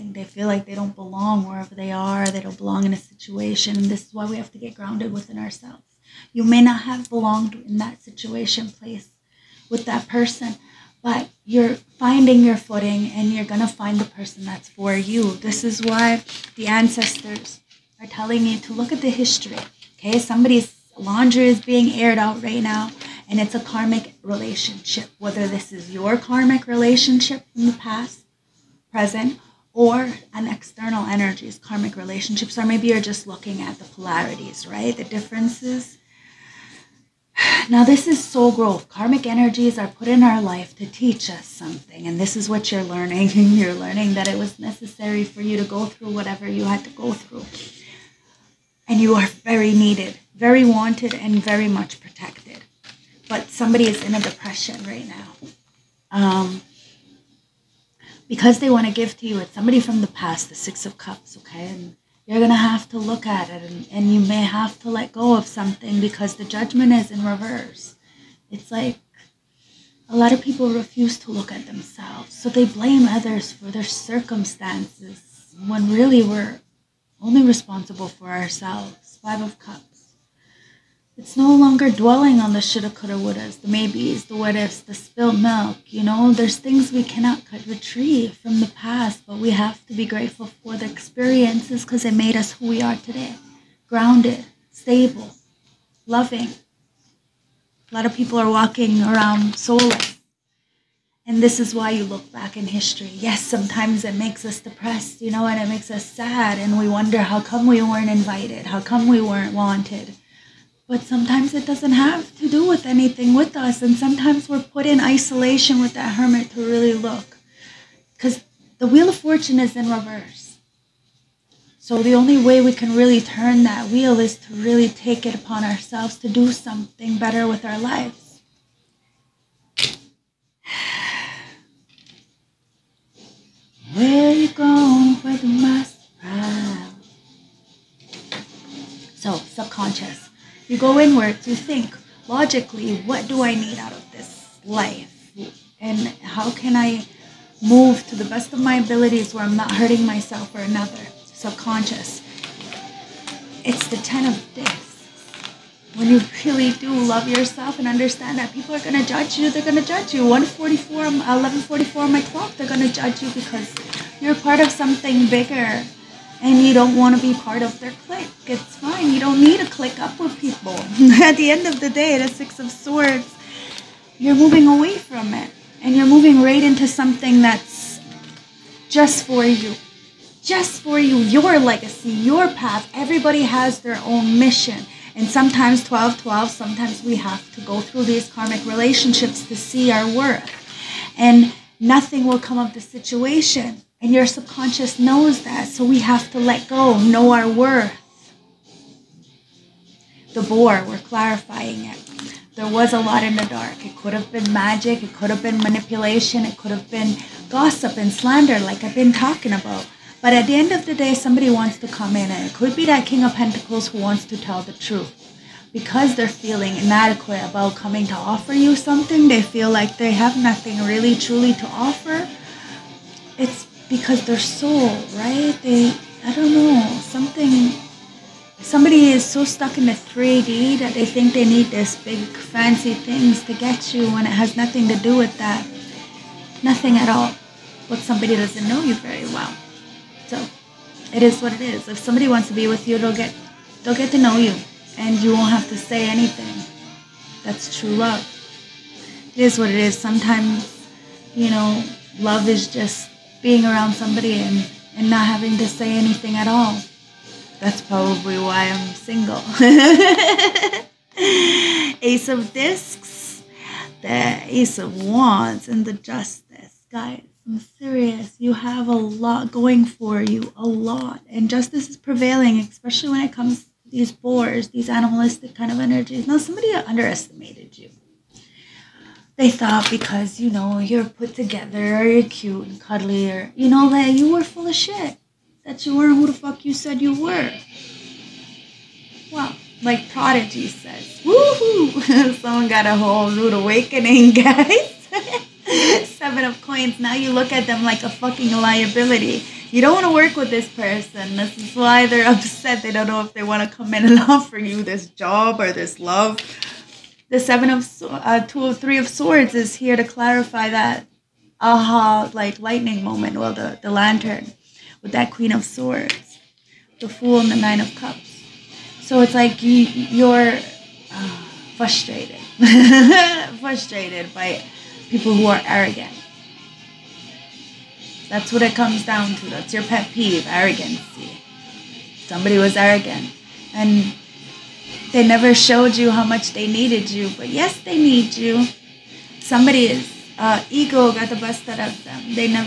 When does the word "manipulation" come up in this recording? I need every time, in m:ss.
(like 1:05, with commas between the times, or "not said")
3:25.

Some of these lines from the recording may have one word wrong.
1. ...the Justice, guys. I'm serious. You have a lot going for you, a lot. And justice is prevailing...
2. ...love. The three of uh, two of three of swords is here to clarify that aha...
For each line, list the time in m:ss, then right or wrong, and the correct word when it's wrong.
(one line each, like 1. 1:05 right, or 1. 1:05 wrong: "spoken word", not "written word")
1. 4:25 right
2. 5:05 wrong: "seven", not "three".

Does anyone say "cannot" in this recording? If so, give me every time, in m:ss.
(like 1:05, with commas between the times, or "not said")
1:27.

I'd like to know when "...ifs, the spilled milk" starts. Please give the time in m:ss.
1:24.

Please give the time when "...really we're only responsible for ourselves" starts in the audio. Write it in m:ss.
1:15.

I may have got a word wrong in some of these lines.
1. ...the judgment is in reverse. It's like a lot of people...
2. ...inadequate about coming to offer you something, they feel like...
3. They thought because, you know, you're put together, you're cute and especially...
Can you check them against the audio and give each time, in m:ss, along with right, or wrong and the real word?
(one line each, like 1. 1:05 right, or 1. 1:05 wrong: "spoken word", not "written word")
1. 1:06 right
2. 3:36 right
3. 4:39 wrong: "cuddly", not "especially".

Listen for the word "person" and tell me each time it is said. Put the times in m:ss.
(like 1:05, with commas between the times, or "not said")
0:10, 0:14, 5:00.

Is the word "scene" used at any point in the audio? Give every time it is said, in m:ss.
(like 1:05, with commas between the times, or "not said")
not said.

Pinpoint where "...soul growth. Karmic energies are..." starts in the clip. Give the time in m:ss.
0:38.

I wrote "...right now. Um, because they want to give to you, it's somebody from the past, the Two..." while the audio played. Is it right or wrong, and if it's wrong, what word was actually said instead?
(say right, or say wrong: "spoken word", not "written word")
wrong: "Six", not "Two".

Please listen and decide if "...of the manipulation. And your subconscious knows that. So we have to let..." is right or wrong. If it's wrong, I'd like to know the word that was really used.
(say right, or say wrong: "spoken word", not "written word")
wrong: "situation", not "manipulation".